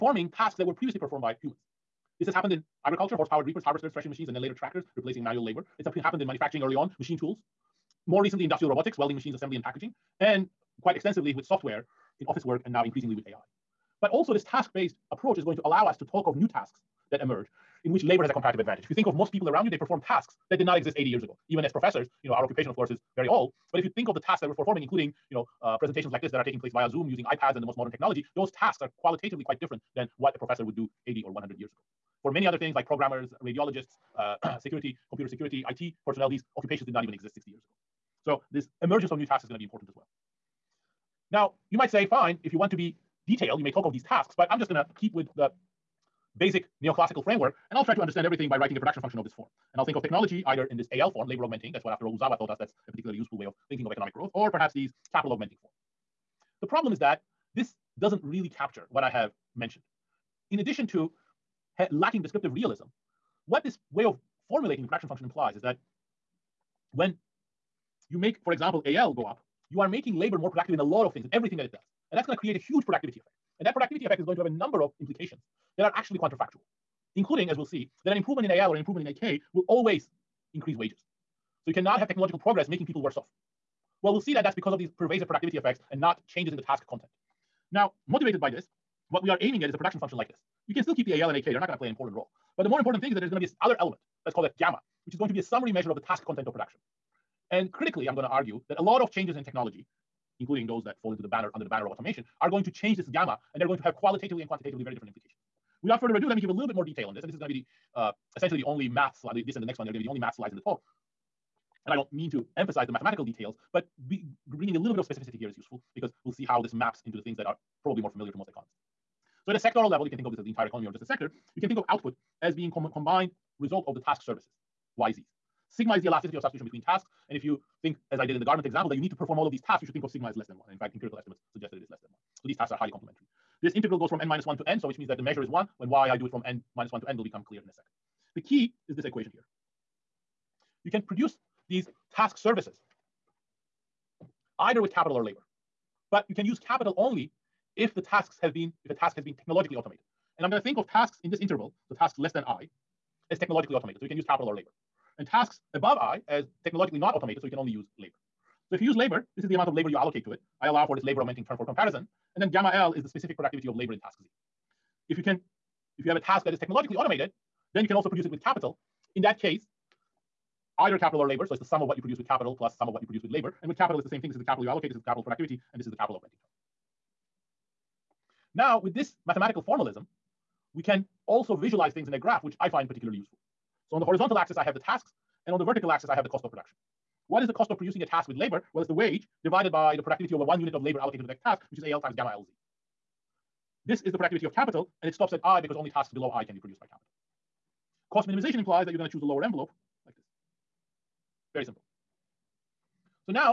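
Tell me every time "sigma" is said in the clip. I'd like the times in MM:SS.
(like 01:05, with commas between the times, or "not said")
02:05, 02:10.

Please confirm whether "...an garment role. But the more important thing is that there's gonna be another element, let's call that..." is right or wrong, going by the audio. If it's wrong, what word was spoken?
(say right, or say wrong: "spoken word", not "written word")
wrong: "important", not "garment".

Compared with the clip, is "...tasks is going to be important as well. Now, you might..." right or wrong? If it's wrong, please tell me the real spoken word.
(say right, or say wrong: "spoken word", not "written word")
right.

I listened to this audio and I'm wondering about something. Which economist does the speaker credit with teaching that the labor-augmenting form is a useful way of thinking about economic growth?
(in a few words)
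Uzawa.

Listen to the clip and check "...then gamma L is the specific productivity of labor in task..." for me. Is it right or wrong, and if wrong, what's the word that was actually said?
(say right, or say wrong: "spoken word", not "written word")
right.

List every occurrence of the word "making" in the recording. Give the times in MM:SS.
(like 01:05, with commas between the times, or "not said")
01:09, 01:22.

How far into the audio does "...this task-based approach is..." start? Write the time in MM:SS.
00:14.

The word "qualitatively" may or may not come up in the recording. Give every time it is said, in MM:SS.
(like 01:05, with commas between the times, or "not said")
00:28, 01:43.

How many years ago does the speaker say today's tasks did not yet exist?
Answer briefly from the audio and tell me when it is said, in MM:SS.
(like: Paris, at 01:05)
80, at 00:20.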